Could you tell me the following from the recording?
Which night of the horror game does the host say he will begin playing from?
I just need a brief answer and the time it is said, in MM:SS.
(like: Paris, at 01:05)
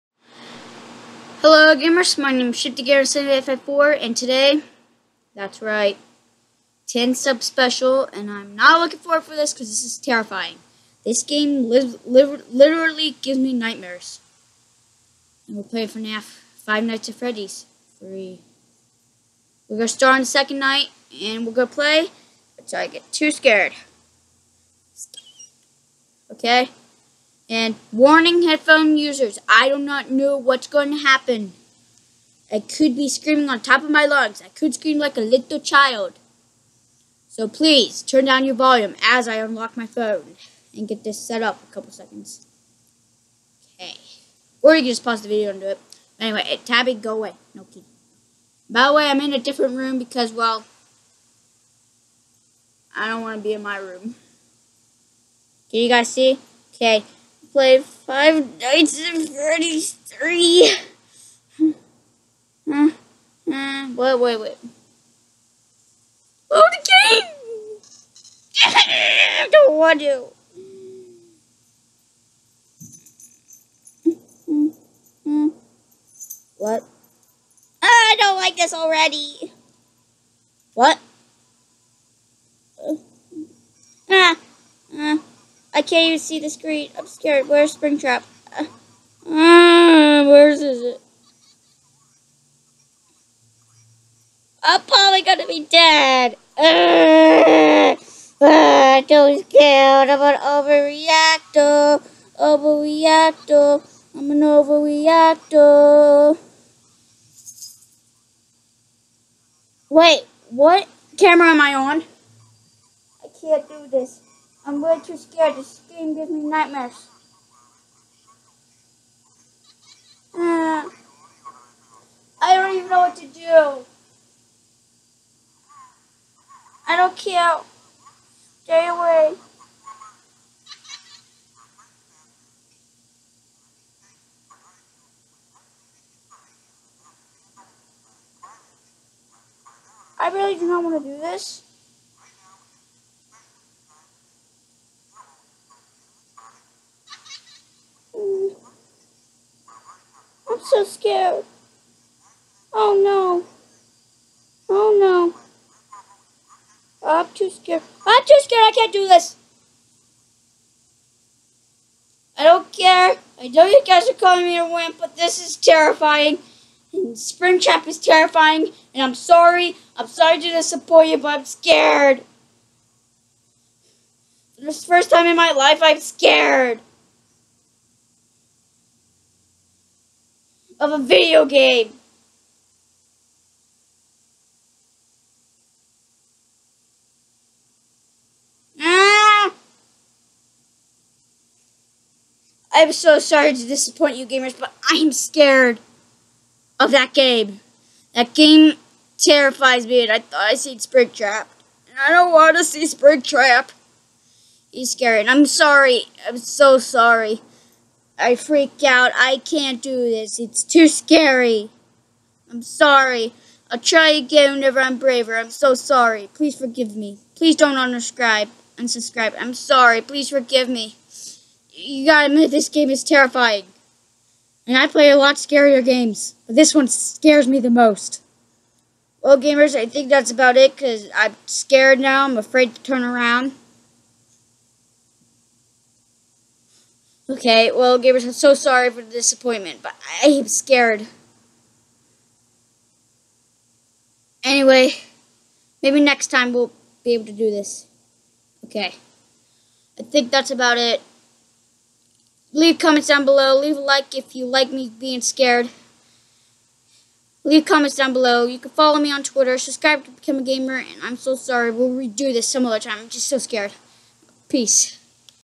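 Second night, at 00:20.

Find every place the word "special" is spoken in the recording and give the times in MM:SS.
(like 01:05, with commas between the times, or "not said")
00:07.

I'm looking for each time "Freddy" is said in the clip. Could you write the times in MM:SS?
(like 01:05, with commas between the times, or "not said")
00:17, 00:59.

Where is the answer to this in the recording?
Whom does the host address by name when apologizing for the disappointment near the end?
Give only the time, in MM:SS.
03:57.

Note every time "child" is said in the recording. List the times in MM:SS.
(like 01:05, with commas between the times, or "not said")
00:35.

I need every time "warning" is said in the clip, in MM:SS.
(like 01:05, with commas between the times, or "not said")
00:27.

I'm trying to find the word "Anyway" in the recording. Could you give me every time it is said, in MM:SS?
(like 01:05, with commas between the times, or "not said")
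00:46, 04:04.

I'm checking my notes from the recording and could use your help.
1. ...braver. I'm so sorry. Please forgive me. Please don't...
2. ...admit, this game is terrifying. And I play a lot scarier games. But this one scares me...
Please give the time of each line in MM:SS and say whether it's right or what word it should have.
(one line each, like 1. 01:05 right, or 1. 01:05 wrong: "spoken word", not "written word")
1. 03:34 right
2. 03:42 right.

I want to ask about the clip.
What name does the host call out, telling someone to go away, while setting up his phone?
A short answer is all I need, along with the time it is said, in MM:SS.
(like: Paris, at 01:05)
Tabby, at 00:46.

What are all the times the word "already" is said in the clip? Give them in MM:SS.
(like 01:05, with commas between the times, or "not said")
01:18.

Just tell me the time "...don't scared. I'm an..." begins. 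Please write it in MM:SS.
01:39.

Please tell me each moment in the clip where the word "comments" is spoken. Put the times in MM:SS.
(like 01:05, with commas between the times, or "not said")
04:12, 04:17.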